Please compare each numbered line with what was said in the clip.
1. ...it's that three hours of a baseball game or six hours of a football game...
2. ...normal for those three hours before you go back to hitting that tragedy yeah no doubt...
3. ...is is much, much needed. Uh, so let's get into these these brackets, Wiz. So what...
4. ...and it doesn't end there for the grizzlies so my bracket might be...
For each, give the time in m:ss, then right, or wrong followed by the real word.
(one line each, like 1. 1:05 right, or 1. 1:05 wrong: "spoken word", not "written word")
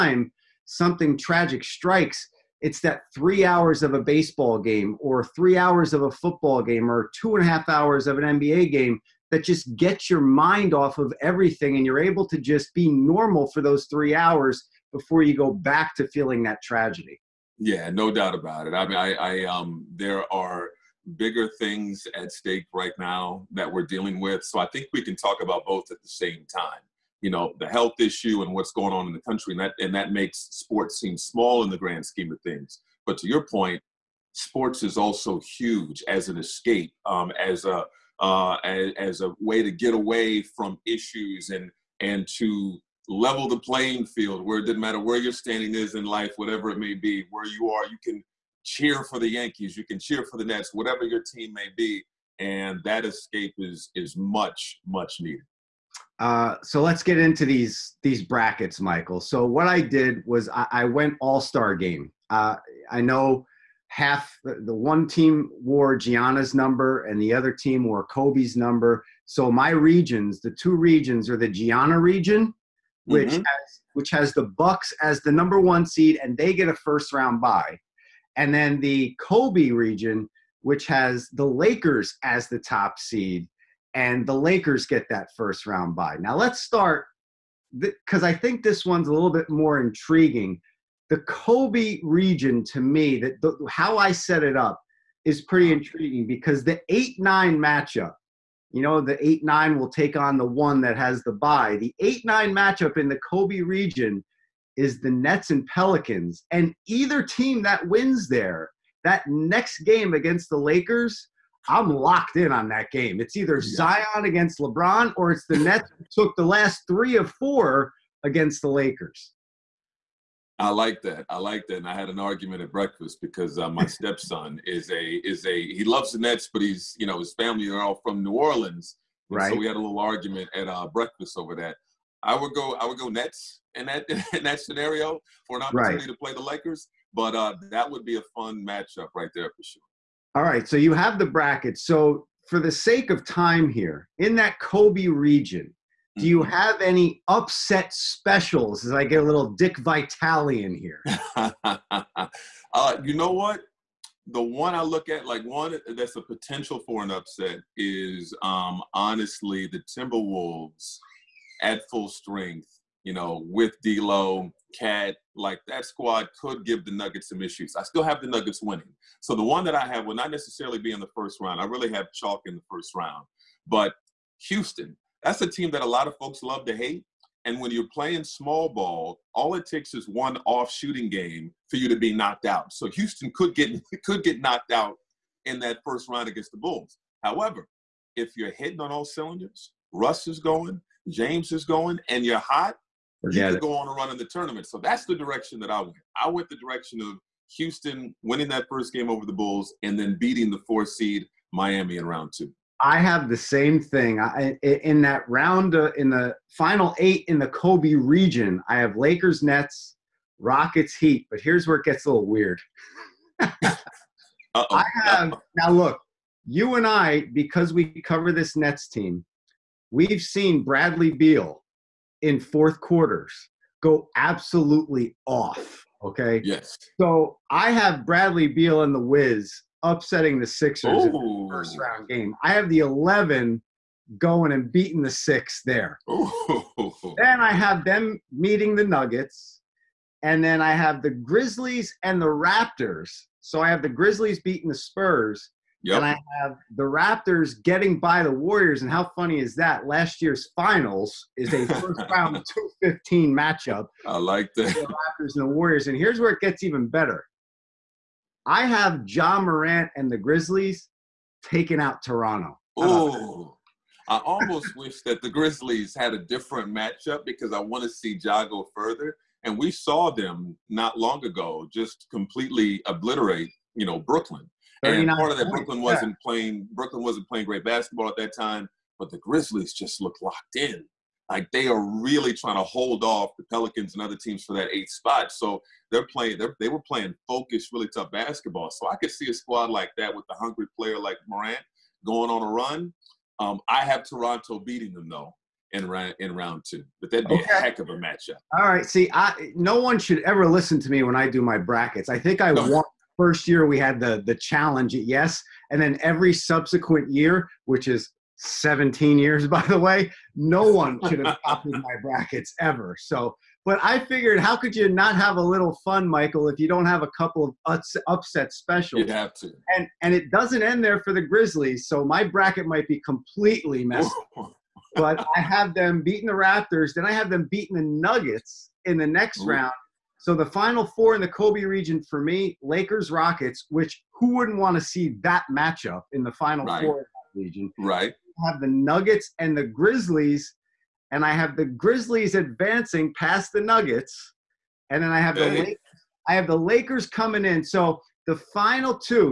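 1. 0:02 wrong: "three", not "six"
2. 0:12 wrong: "feeling", not "hitting"
3. 0:53 wrong: "Michael", not "Wiz"
4. 5:20 right.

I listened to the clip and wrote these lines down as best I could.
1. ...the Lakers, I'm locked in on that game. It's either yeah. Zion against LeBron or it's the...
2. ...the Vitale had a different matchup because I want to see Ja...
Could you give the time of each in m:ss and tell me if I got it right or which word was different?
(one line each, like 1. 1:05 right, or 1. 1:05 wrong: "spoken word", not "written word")
1. 1:50 right
2. 4:25 wrong: "Grizzlies", not "Vitale".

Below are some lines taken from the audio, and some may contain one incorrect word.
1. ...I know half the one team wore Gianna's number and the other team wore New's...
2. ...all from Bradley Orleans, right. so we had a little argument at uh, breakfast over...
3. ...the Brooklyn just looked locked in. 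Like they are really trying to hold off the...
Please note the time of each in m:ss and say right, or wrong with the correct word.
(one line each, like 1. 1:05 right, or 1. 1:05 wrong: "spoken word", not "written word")
1. 1:02 wrong: "Kobe", not "New"
2. 2:07 wrong: "New", not "Bradley"
3. 4:39 wrong: "Grizzlies", not "Brooklyn".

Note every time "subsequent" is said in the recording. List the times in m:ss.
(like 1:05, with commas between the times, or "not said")
5:06.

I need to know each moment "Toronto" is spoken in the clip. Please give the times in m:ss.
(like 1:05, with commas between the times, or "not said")
4:22, 4:54.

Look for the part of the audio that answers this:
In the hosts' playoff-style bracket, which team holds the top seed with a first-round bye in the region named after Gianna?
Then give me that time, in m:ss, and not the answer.
1:14.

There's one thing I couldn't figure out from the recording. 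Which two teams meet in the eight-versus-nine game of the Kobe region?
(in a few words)
Nets and Pelicans.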